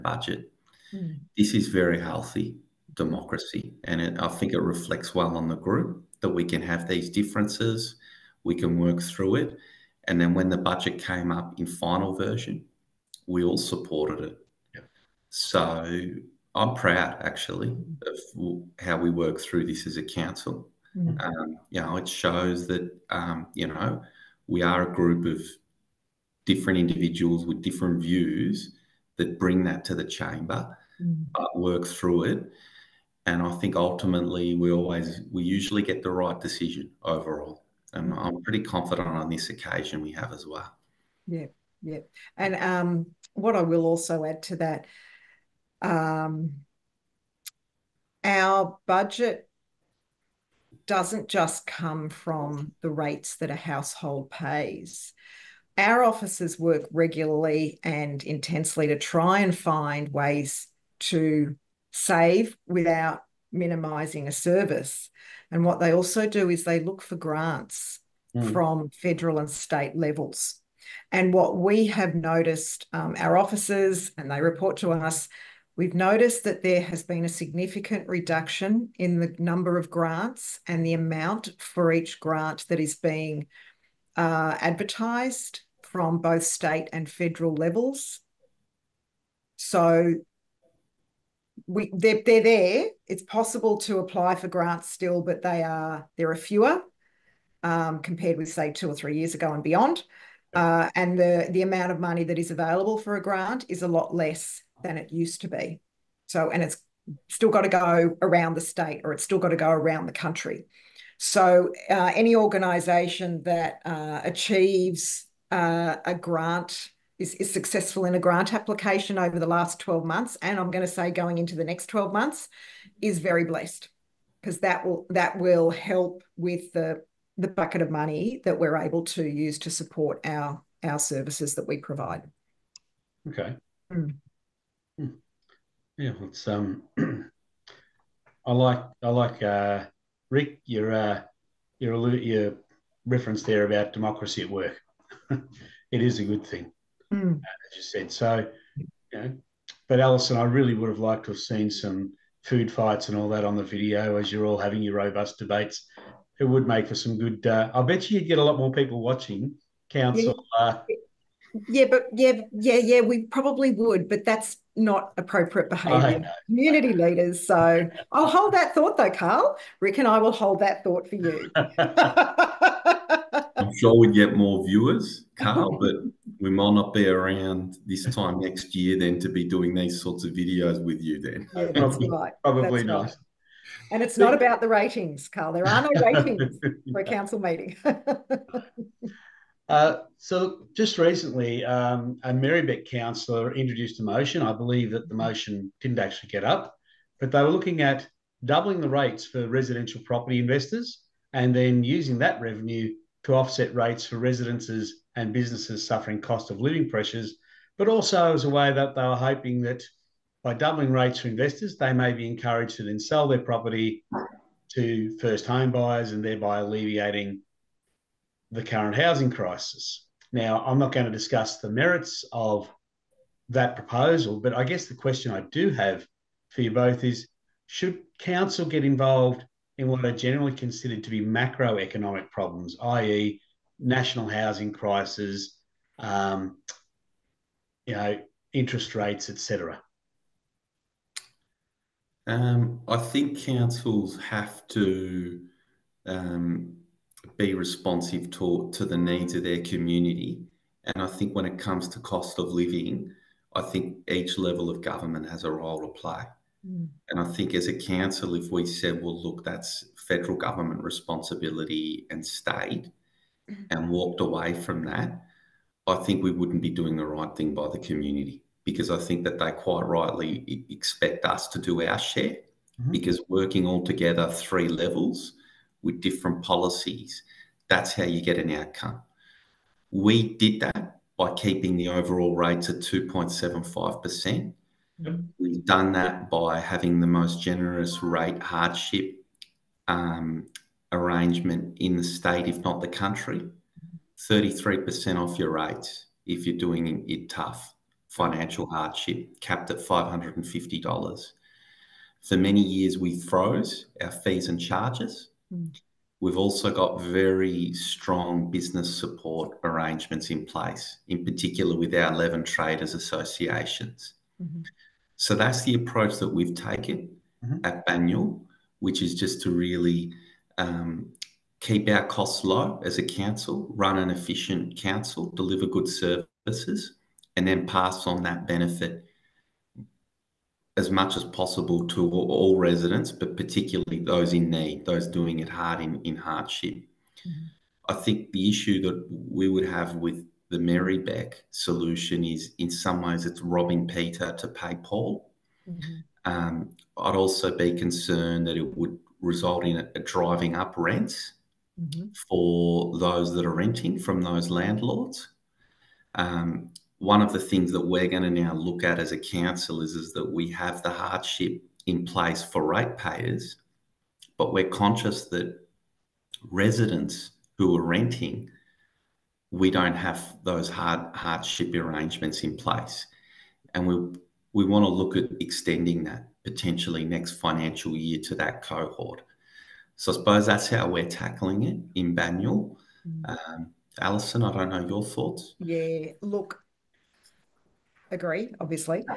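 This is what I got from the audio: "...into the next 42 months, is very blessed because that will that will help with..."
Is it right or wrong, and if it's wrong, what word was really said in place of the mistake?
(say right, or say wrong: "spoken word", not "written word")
wrong: "12", not "42".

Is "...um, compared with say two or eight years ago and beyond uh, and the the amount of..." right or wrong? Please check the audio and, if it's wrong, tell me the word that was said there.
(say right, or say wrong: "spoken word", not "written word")
wrong: "three", not "eight".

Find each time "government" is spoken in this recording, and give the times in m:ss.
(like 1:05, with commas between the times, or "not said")
4:14, 4:20.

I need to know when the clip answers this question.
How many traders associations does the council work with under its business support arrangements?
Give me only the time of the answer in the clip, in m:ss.
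5:12.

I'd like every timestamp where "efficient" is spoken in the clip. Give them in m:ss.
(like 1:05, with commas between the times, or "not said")
5:24.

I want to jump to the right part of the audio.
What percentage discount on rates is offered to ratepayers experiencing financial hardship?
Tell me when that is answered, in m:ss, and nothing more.
4:54.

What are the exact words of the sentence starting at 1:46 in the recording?
So, and it's still got to go around the state, or it's still got to go around the country.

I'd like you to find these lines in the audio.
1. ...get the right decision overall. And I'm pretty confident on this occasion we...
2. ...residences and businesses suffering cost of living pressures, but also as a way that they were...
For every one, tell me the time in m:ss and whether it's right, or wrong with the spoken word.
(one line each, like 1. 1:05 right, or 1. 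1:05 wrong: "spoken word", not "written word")
1. 0:35 right
2. 3:24 right.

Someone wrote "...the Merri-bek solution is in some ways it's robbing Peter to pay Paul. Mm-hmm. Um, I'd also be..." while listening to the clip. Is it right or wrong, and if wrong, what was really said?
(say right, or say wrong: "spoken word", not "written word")
right.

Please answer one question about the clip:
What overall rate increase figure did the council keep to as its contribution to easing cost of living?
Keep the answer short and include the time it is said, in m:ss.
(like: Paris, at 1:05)
2.75%, at 4:42.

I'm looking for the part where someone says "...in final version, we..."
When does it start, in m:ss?
0:11.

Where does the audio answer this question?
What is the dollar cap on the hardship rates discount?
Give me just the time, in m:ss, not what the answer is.
4:59.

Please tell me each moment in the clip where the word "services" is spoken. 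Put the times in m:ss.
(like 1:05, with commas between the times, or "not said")
1:04, 2:10, 5:25.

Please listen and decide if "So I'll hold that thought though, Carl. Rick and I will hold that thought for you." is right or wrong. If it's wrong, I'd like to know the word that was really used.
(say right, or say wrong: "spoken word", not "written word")
right.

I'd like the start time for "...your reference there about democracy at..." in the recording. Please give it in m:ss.
2:22.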